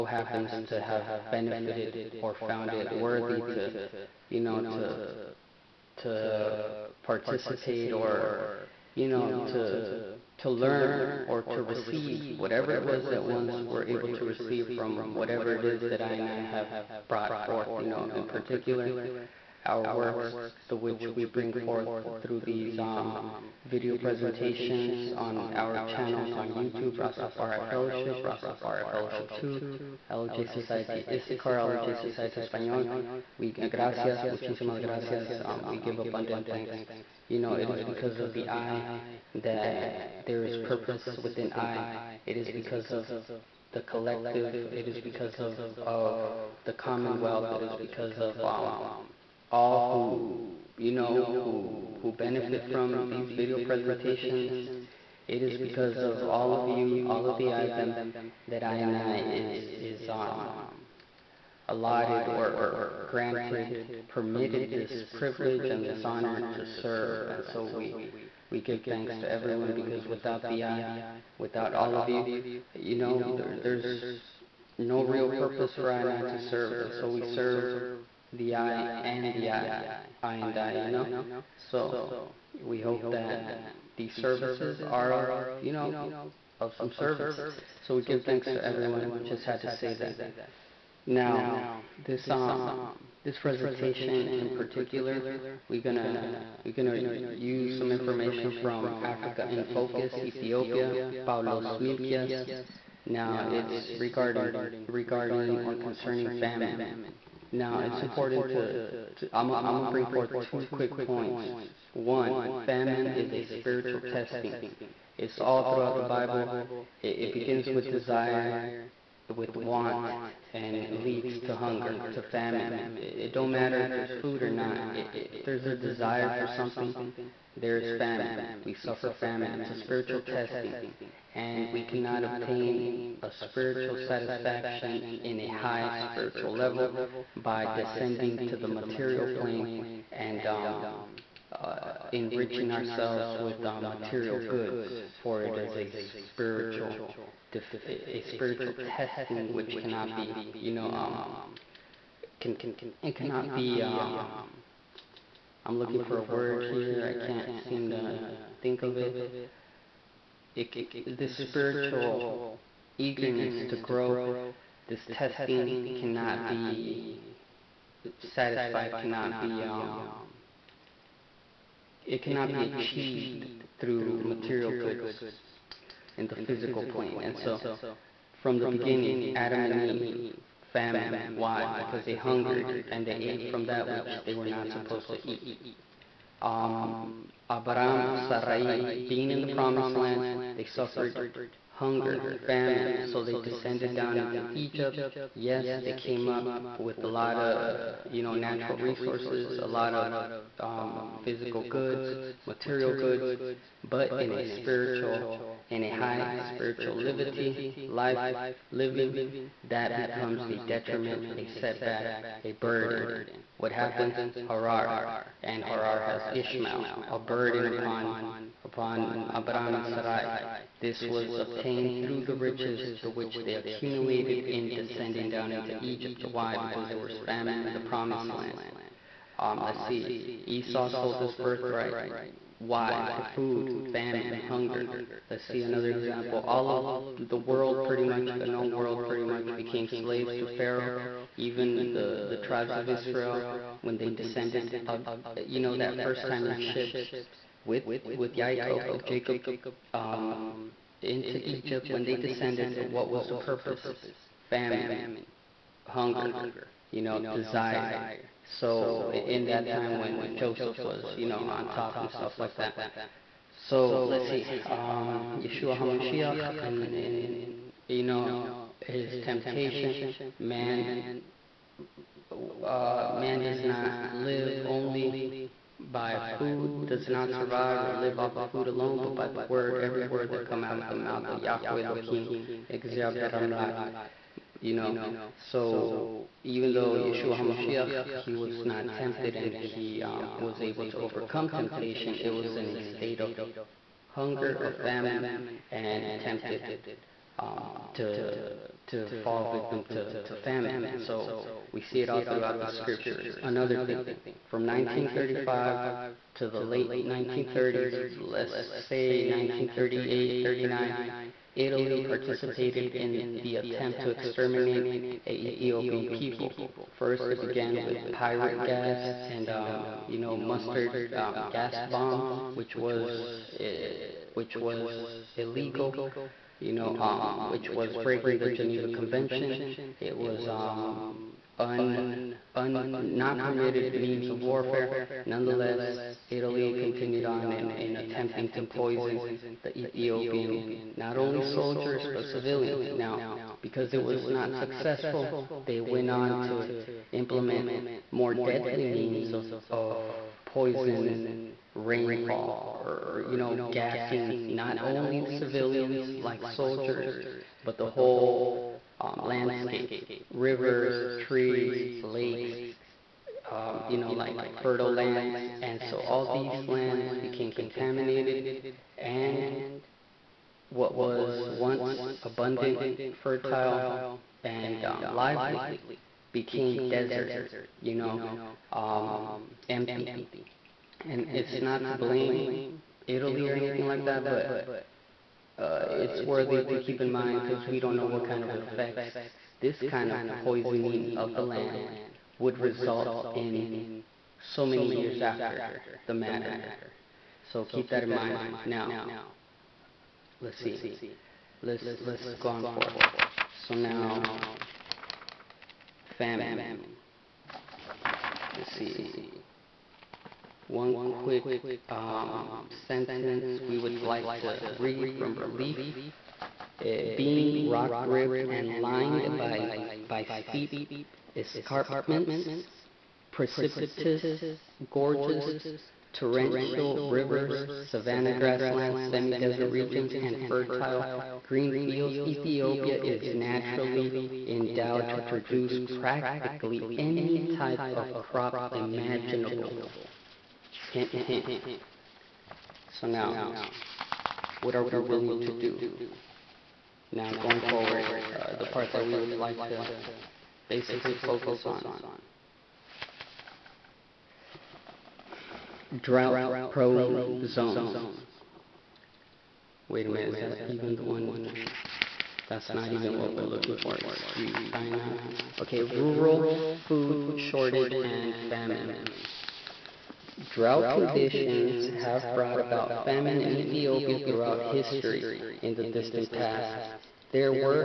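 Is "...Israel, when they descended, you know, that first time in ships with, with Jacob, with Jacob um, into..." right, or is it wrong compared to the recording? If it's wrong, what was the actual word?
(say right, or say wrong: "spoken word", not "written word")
right.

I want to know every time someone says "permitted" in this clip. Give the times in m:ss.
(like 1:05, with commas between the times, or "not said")
1:04, 5:33.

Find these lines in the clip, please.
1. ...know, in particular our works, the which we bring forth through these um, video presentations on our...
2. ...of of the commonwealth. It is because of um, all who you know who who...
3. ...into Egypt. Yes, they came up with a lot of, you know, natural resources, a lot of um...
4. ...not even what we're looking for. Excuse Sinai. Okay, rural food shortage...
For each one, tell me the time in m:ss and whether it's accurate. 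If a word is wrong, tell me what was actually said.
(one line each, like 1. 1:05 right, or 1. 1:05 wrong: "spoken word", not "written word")
1. 0:17 right
2. 0:45 right
3. 3:14 right
4. 7:42 right.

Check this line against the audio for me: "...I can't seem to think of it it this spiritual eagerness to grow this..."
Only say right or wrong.
right.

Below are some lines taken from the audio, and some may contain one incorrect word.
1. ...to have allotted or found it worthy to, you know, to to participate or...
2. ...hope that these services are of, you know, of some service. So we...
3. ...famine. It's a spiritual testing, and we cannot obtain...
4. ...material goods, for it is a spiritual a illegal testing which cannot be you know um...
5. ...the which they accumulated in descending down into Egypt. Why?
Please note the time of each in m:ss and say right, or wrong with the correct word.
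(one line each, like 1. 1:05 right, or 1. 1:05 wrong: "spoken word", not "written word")
1. 0:00 wrong: "benefited", not "allotted"
2. 1:22 right
3. 2:09 right
4. 2:23 wrong: "spiritual", not "illegal"
5. 3:43 right.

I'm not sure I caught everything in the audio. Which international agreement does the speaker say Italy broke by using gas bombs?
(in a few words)
Geneva Convention.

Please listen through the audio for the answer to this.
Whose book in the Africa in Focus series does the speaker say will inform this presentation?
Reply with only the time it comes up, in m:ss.
1:41.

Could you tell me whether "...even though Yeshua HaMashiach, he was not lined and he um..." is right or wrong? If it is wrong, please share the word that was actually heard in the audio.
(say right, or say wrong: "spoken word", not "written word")
wrong: "tempted", not "lined".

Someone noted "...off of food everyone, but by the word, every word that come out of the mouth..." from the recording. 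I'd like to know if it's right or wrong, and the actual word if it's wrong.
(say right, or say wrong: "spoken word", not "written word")
wrong: "alone", not "everyone".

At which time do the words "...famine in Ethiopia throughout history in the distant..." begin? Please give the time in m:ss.
7:53.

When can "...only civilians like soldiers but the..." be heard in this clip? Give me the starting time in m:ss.
5:54.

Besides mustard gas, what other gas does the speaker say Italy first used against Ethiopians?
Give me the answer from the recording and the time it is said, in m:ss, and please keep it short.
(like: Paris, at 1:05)
yperite, at 5:18.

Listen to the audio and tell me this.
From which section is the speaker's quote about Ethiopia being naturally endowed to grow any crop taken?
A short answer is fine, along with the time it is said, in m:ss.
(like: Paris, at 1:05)
Relief, at 6:55.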